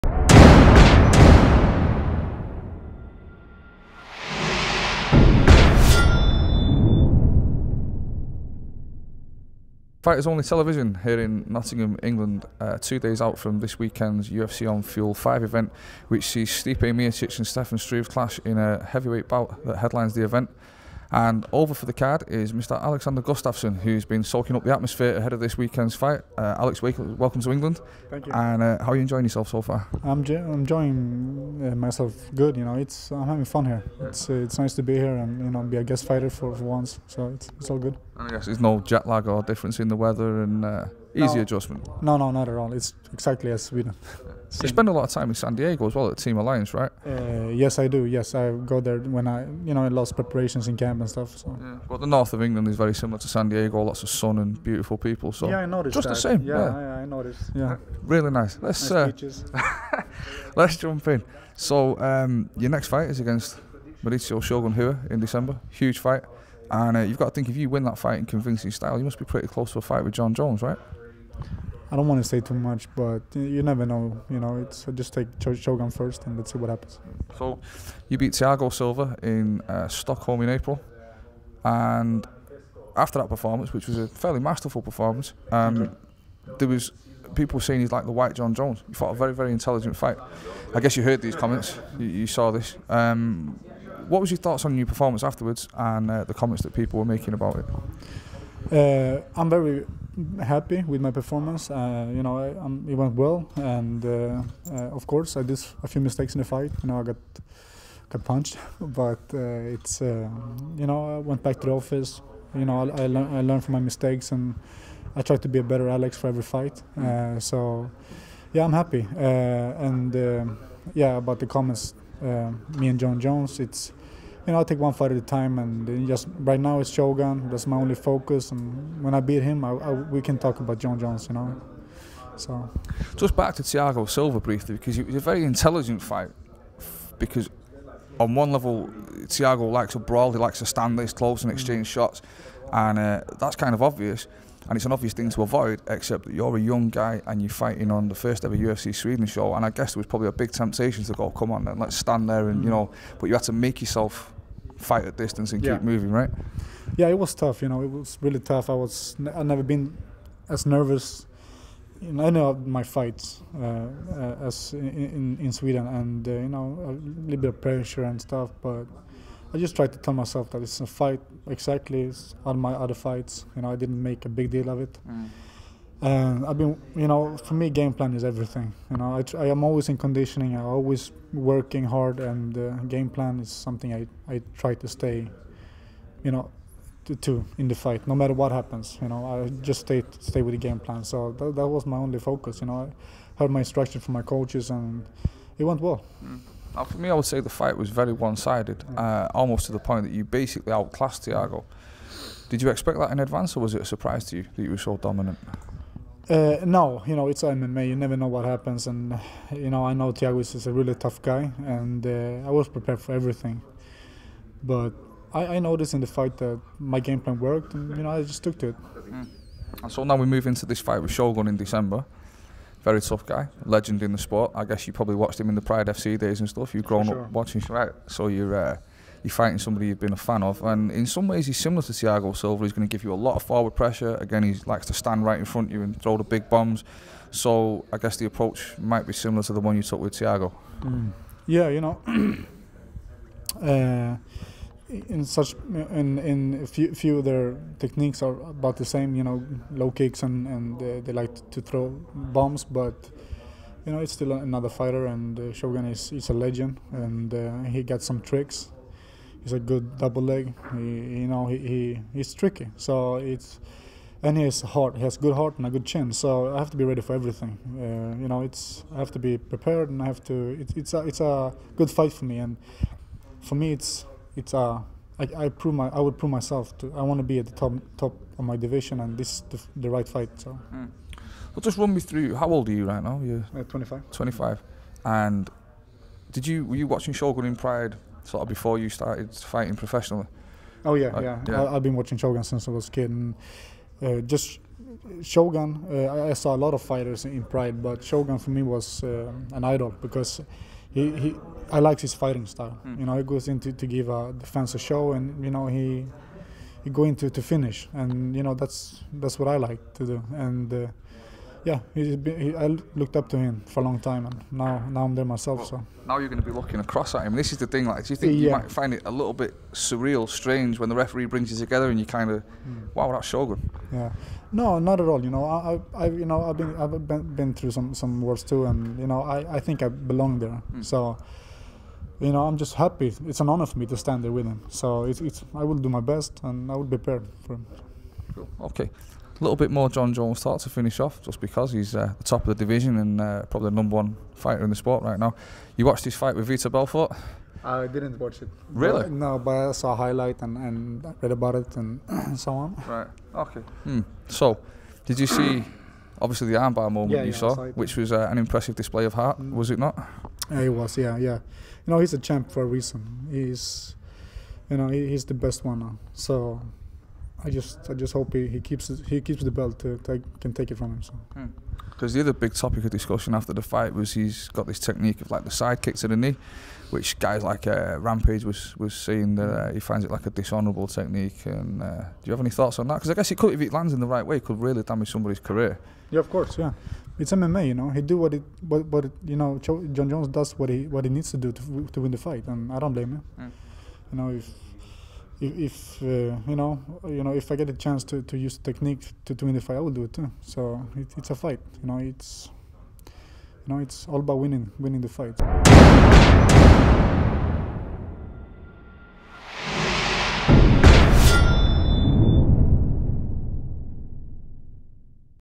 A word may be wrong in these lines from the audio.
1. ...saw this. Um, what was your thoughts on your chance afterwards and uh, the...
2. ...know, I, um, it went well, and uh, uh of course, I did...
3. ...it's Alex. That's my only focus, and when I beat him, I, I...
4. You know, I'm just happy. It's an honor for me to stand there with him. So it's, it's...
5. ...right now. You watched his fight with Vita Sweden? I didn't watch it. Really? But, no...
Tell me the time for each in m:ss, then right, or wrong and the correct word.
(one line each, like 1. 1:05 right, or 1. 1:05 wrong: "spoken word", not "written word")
1. 1:32 wrong: "performance", not "chance"
2. 1:42 right
3. 2:06 wrong: "Shogun", not "Alex"
4. 5:32 right
5. 5:45 wrong: "Belfort", not "Sweden".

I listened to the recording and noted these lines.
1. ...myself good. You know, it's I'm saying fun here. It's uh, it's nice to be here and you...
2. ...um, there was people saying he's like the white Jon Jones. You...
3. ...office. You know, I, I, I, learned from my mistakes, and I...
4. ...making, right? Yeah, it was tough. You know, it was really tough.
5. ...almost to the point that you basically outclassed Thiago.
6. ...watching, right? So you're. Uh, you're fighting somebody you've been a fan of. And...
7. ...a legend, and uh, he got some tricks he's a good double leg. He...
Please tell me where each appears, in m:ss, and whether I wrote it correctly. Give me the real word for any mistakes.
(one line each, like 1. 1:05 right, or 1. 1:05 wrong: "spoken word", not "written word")
1. 0:31 wrong: "having", not "saying"
2. 1:25 right
3. 1:51 right
4. 2:35 wrong: "moving", not "making"
5. 3:19 right
6. 3:47 right
7. 4:16 right.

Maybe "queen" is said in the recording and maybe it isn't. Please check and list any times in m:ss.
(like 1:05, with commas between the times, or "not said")
not said.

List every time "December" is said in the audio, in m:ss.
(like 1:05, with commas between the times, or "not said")
1:05, 3:41.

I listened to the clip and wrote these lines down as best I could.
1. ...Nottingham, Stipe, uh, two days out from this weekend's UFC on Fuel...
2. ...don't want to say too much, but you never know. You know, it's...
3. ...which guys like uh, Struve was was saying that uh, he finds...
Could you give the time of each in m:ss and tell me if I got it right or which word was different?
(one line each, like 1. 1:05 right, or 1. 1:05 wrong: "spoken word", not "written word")
1. 0:11 wrong: "England", not "Stipe"
2. 1:11 right
3. 6:16 wrong: "Rampage", not "Struve".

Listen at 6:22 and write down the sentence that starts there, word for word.
Because I guess it could, if it lands in the right way, it could really damage somebody's career.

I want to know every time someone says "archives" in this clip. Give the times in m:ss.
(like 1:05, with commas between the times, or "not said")
not said.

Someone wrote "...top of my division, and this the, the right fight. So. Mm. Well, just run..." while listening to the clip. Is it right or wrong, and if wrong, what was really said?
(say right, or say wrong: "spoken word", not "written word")
right.